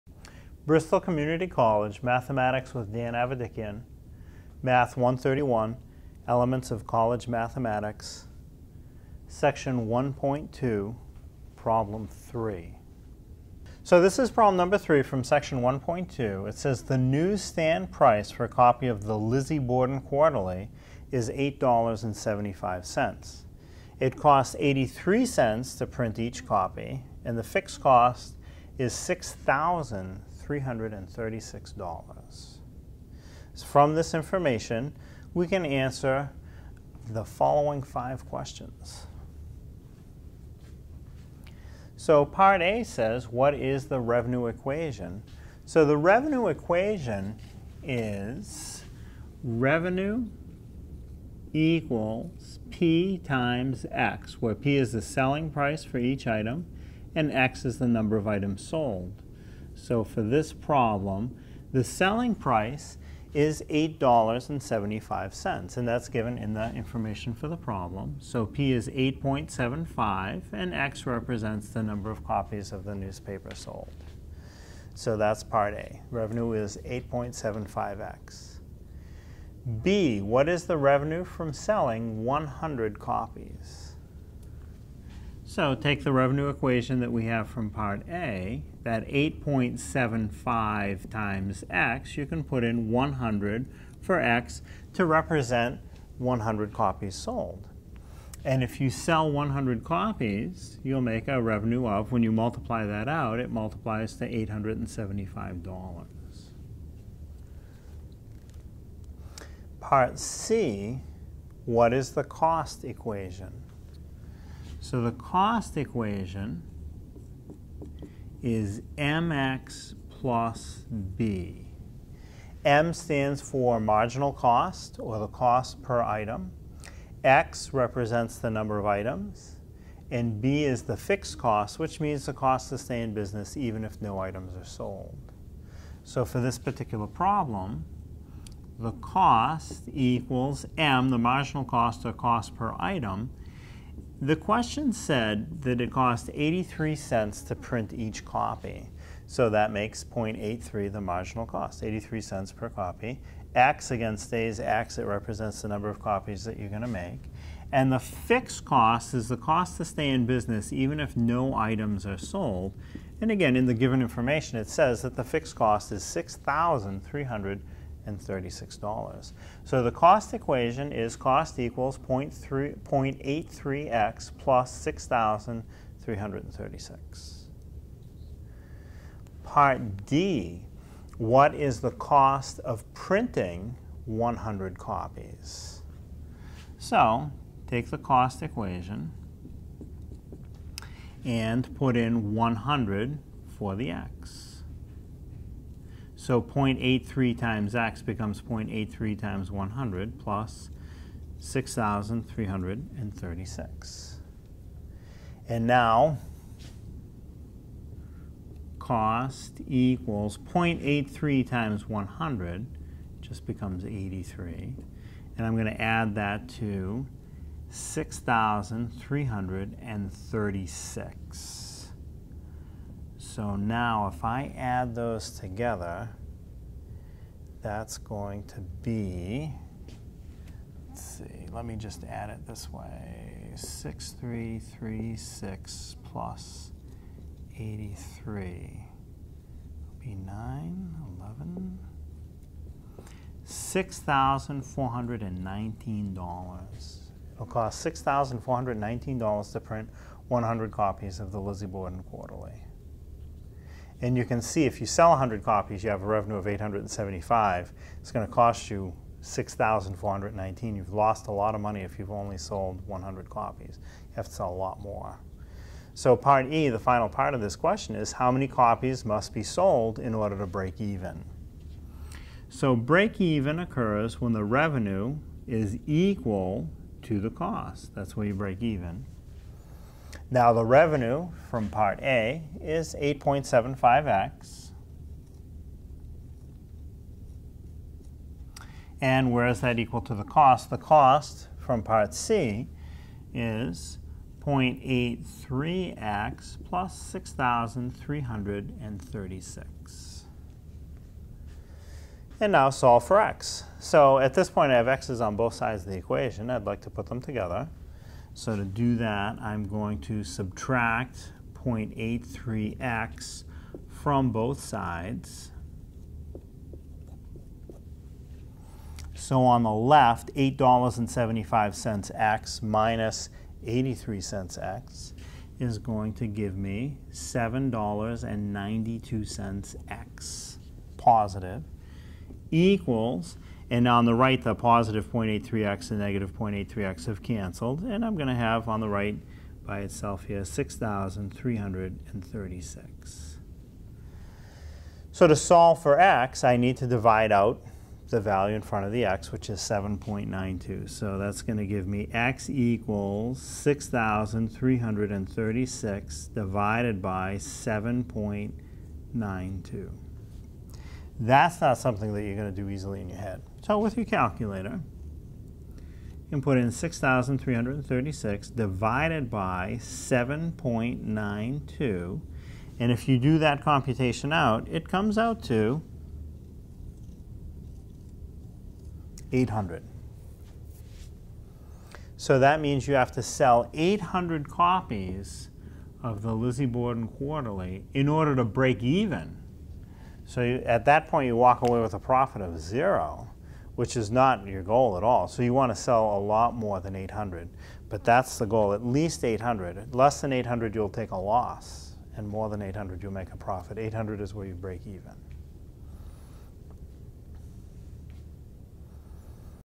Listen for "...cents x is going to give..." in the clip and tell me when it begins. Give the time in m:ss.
5:24.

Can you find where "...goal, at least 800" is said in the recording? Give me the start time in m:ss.
6:38.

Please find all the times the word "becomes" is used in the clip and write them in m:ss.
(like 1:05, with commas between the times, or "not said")
3:18, 3:33.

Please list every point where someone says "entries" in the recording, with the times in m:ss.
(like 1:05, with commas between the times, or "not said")
not said.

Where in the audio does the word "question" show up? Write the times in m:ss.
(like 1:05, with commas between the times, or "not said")
0:38, 2:24, 4:27.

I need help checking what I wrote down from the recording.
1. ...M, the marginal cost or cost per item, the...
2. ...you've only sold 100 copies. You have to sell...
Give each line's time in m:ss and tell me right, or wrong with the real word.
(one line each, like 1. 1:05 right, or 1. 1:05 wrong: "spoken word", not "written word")
1. 2:20 right
2. 4:21 right.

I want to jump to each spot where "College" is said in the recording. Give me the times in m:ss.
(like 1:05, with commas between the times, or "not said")
0:01, 0:06.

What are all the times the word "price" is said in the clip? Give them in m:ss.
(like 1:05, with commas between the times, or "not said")
0:17, 0:55, 1:02.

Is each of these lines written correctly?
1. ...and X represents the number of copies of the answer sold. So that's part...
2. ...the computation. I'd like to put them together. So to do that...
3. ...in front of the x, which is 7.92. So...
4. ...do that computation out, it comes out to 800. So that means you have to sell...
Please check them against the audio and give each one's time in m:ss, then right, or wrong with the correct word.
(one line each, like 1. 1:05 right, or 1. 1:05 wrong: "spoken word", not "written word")
1. 1:10 wrong: "newspaper", not "answer"
2. 5:05 wrong: "equation", not "computation"
3. 5:48 right
4. 6:13 right.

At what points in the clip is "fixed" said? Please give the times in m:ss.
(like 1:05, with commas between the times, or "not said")
0:27, 2:10, 2:37, 2:45.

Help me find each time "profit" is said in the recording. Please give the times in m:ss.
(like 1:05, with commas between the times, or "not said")
6:31, 6:43.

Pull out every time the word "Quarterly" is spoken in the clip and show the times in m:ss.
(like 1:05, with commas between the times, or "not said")
0:20, 4:12, 6:27.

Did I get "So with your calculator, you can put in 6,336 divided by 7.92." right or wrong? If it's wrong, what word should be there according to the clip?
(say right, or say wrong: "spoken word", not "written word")
right.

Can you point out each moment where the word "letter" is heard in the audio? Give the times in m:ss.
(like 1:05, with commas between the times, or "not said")
not said.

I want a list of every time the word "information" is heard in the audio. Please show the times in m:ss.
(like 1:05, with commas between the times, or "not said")
0:34, 1:06, 2:44.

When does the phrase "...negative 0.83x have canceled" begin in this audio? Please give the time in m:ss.
5:35.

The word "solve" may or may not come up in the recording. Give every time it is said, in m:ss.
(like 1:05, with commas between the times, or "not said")
5:02, 5:45.